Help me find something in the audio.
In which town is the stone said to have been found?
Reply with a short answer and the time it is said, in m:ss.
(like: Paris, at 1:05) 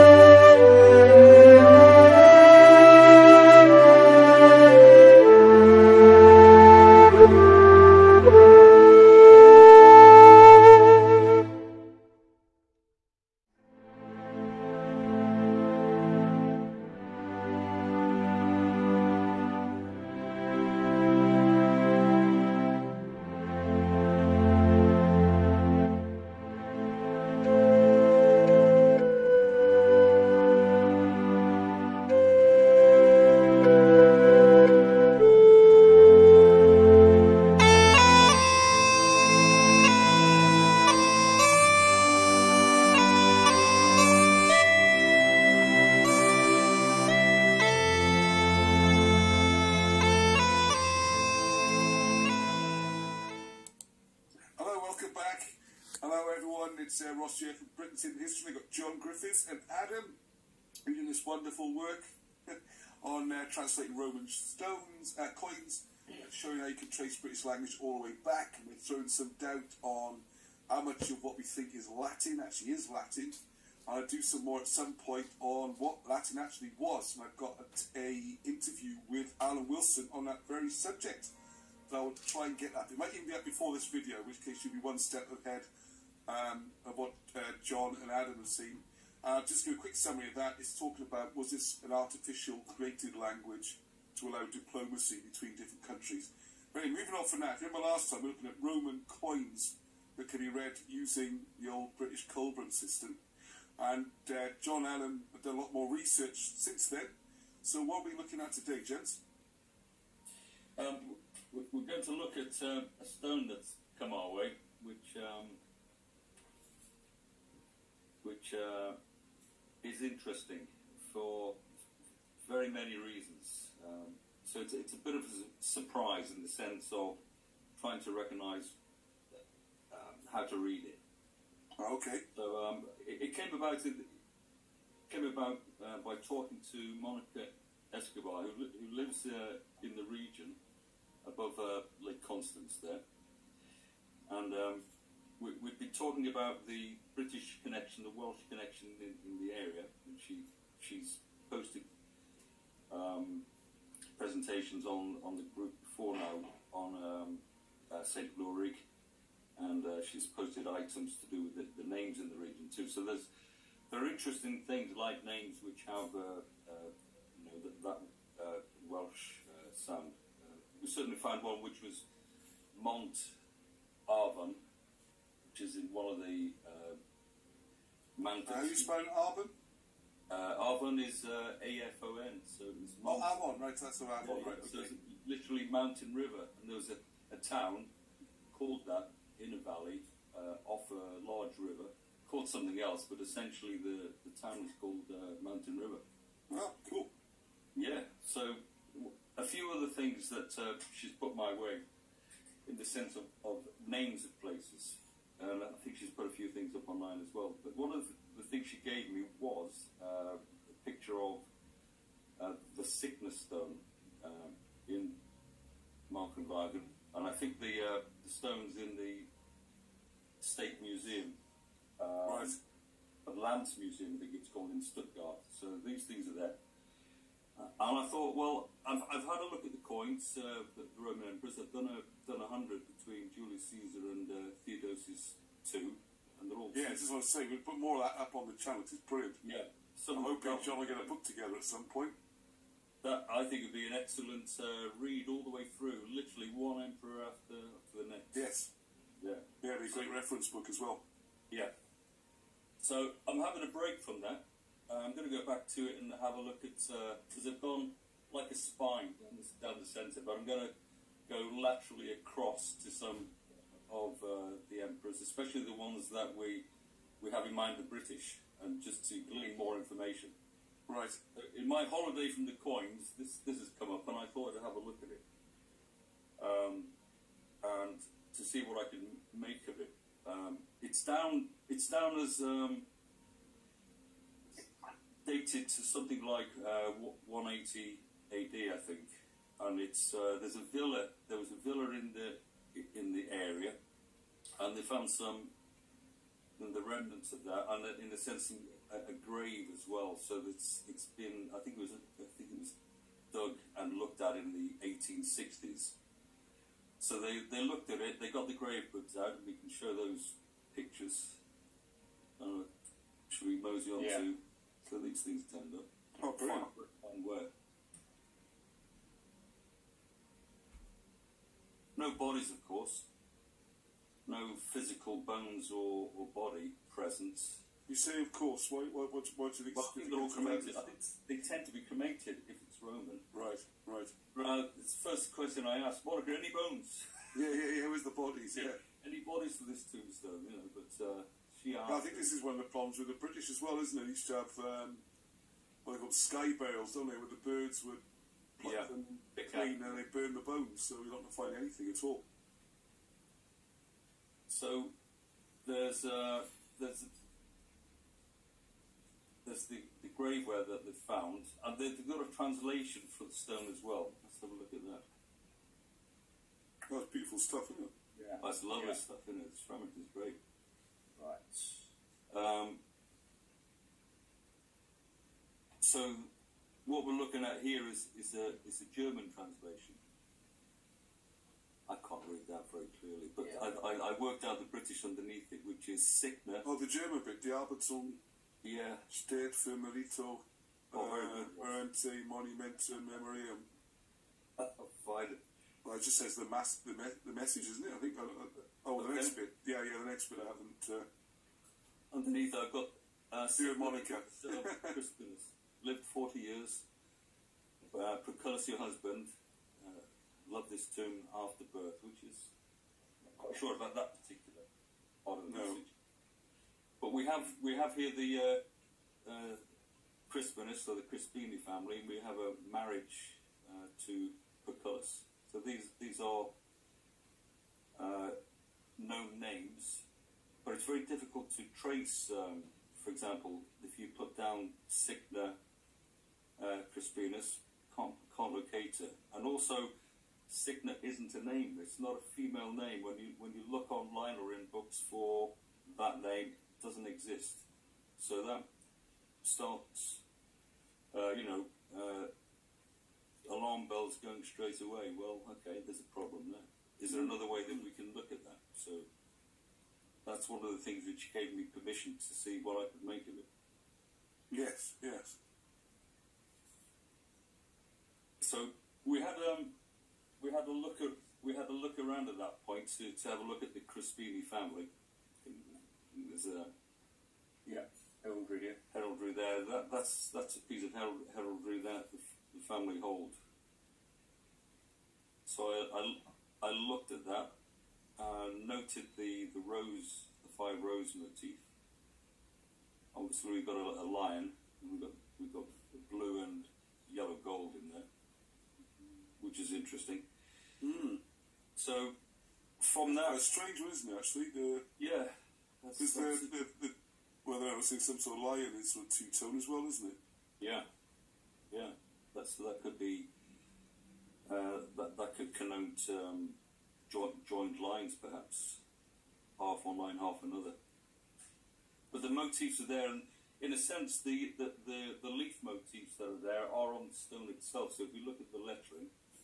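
Mochenwangen, at 3:36.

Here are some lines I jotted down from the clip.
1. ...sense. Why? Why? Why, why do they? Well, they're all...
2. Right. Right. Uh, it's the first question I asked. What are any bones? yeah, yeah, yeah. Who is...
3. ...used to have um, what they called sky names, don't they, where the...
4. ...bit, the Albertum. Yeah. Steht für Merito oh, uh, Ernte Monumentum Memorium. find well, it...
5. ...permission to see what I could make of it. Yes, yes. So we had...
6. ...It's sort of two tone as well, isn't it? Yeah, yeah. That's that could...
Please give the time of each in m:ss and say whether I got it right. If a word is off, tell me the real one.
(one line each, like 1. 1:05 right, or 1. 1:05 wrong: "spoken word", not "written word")
1. 5:28 wrong: "course", not "sense"
2. 5:33 right
3. 5:44 wrong: "bales", not "names"
4. 6:27 right
5. 7:41 right
6. 8:28 right.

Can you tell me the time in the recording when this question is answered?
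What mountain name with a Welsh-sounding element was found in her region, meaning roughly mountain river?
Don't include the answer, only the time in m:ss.
2:52.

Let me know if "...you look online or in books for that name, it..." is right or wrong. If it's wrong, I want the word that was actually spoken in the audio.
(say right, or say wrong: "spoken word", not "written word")
right.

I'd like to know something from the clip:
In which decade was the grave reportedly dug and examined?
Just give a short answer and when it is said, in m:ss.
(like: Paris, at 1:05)
1860s, at 5:04.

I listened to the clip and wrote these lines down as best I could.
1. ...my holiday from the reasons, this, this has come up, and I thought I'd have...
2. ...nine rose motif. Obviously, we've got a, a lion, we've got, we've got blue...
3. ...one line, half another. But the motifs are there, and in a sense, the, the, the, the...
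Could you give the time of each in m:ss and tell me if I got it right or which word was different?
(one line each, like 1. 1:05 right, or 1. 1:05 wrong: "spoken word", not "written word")
1. 4:31 wrong: "coins", not "reasons"
2. 8:10 wrong: "five", not "nine"
3. 8:39 right.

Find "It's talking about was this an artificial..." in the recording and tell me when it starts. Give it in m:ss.
1:30.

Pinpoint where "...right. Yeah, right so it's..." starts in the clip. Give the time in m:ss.
3:04.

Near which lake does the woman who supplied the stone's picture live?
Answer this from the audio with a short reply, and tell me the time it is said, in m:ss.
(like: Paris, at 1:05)
Lake Constance, at 2:22.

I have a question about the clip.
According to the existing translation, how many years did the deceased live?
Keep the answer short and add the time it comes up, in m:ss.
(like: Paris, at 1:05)
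40, at 6:46.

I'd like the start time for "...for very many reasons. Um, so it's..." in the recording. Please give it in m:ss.
2:01.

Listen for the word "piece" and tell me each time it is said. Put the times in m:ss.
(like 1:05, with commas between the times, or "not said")
8:00.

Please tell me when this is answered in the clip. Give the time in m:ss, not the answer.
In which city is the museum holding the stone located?
3:44.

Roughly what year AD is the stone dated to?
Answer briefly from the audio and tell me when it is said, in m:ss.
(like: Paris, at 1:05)
180 AD, at 4:47.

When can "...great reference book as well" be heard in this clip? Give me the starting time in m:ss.
4:10.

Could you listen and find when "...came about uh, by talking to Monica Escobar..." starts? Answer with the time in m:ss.
2:15.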